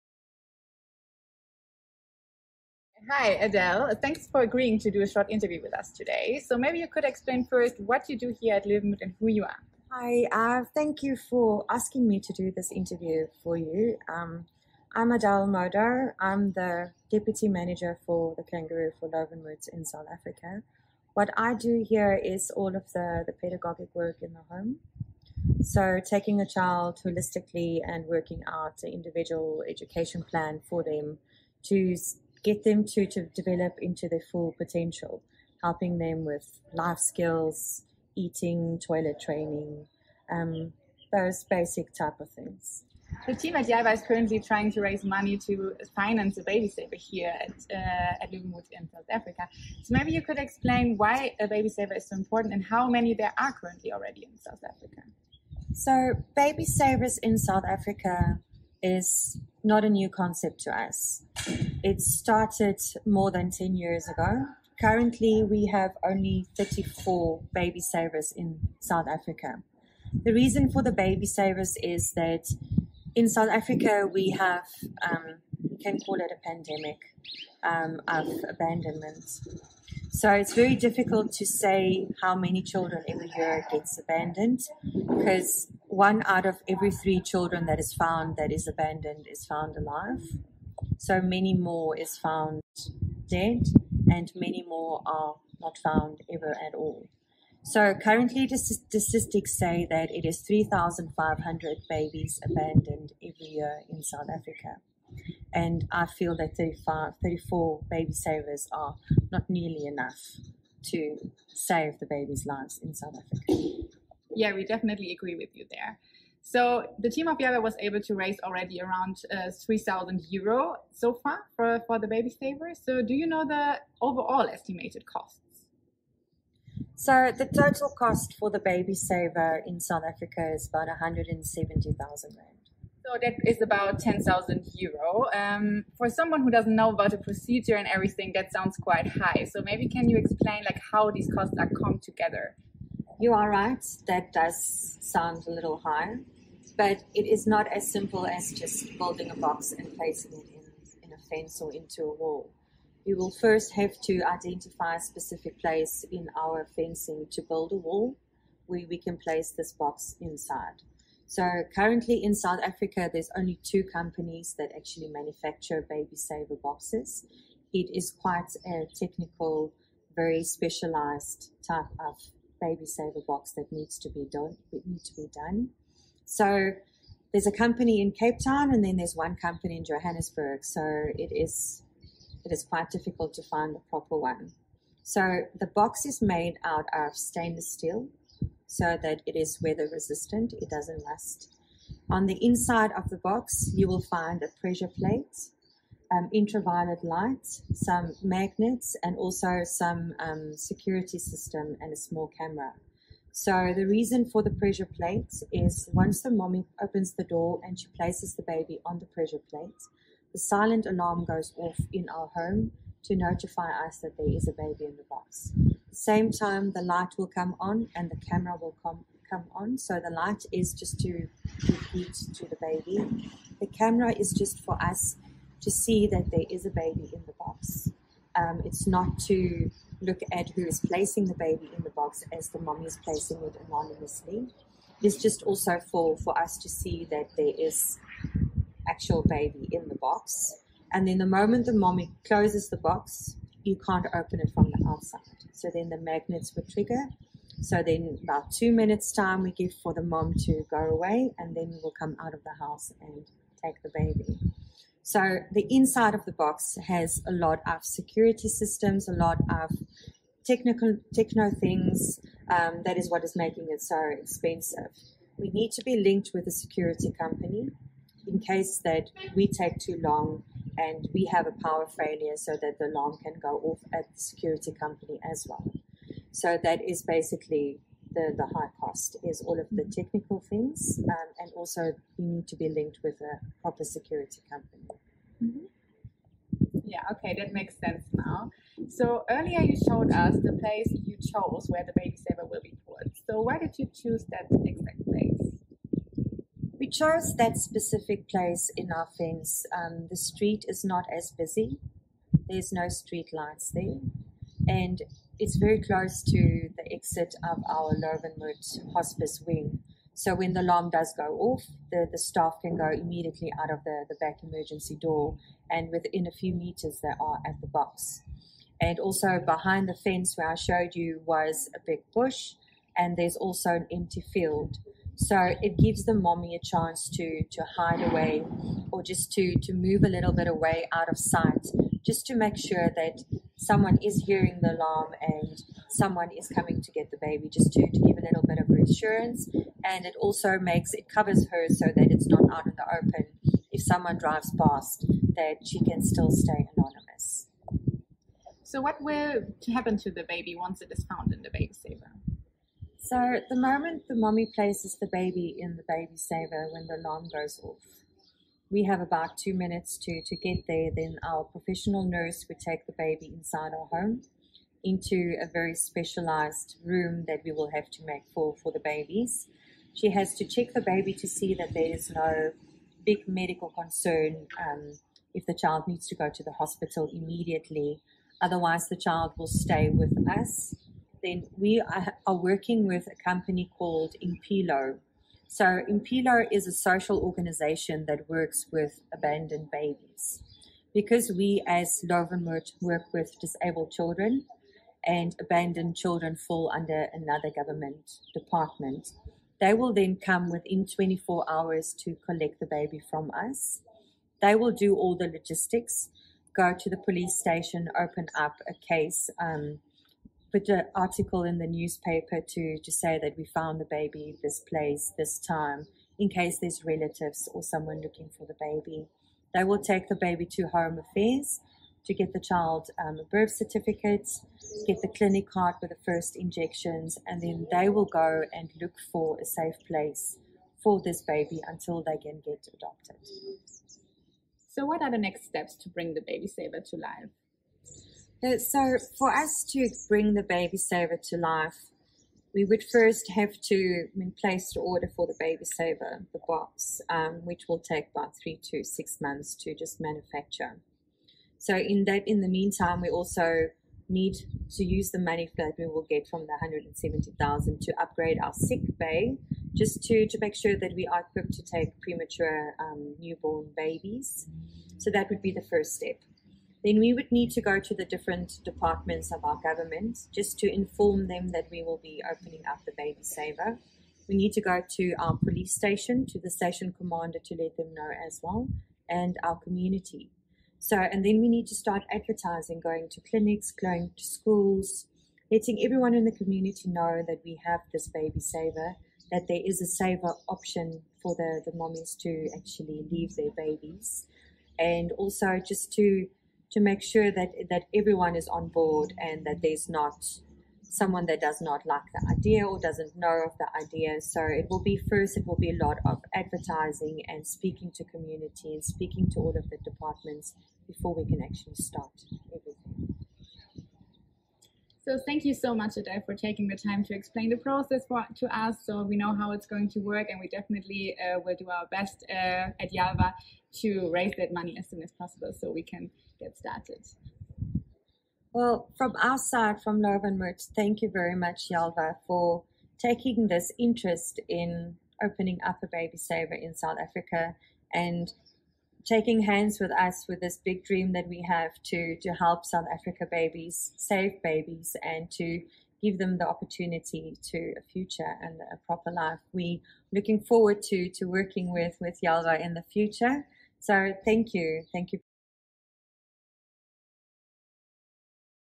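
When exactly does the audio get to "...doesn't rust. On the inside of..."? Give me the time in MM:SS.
03:10.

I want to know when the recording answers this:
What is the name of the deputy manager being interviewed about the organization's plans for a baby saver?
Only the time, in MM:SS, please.
00:15.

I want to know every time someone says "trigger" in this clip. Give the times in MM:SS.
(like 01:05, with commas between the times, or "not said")
04:06.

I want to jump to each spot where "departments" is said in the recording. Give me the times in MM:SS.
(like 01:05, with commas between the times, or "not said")
06:38, 07:48, 08:29.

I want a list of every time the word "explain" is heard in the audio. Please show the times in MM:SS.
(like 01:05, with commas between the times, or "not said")
00:07, 00:50, 02:20, 08:37.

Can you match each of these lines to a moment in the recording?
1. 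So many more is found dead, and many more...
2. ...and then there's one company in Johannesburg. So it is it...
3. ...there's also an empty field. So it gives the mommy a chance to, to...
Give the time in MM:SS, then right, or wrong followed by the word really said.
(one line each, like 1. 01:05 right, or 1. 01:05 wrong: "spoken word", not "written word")
1. 01:30 right
2. 02:58 right
3. 05:23 right.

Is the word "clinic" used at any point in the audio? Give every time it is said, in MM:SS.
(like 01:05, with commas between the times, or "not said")
07:05, 08:03.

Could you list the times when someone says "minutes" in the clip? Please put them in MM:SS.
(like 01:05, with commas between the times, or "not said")
04:08, 05:59.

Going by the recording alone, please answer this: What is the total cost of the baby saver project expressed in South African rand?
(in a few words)
170,000 rand.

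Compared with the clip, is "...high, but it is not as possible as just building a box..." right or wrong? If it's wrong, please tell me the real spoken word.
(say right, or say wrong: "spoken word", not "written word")
wrong: "simple", not "possible".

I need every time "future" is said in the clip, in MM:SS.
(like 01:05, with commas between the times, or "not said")
09:07, 09:12.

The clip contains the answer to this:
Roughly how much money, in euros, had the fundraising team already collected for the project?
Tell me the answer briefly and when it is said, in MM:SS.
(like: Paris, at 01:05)
3,000 euro, at 01:59.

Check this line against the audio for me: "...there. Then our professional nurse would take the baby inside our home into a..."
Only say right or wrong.
right.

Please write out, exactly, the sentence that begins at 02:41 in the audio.
So currently in South Africa, there's only two companies that actually manufacture baby saver boxes.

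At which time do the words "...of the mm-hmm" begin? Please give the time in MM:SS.
04:39.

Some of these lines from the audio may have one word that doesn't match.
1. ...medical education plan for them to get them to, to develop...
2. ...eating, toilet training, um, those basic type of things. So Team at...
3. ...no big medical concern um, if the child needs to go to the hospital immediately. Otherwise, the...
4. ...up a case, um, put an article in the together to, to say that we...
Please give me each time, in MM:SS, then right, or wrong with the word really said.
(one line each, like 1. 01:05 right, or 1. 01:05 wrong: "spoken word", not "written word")
1. 00:28 wrong: "individual", not "medical"
2. 00:38 right
3. 06:12 right
4. 06:48 wrong: "newspaper", not "together".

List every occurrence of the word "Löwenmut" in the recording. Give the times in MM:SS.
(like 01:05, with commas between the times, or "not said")
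00:08, 00:19, 00:48, 05:07, 06:32, 08:50.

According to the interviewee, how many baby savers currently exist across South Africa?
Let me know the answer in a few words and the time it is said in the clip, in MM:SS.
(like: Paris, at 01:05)
34, at 01:05.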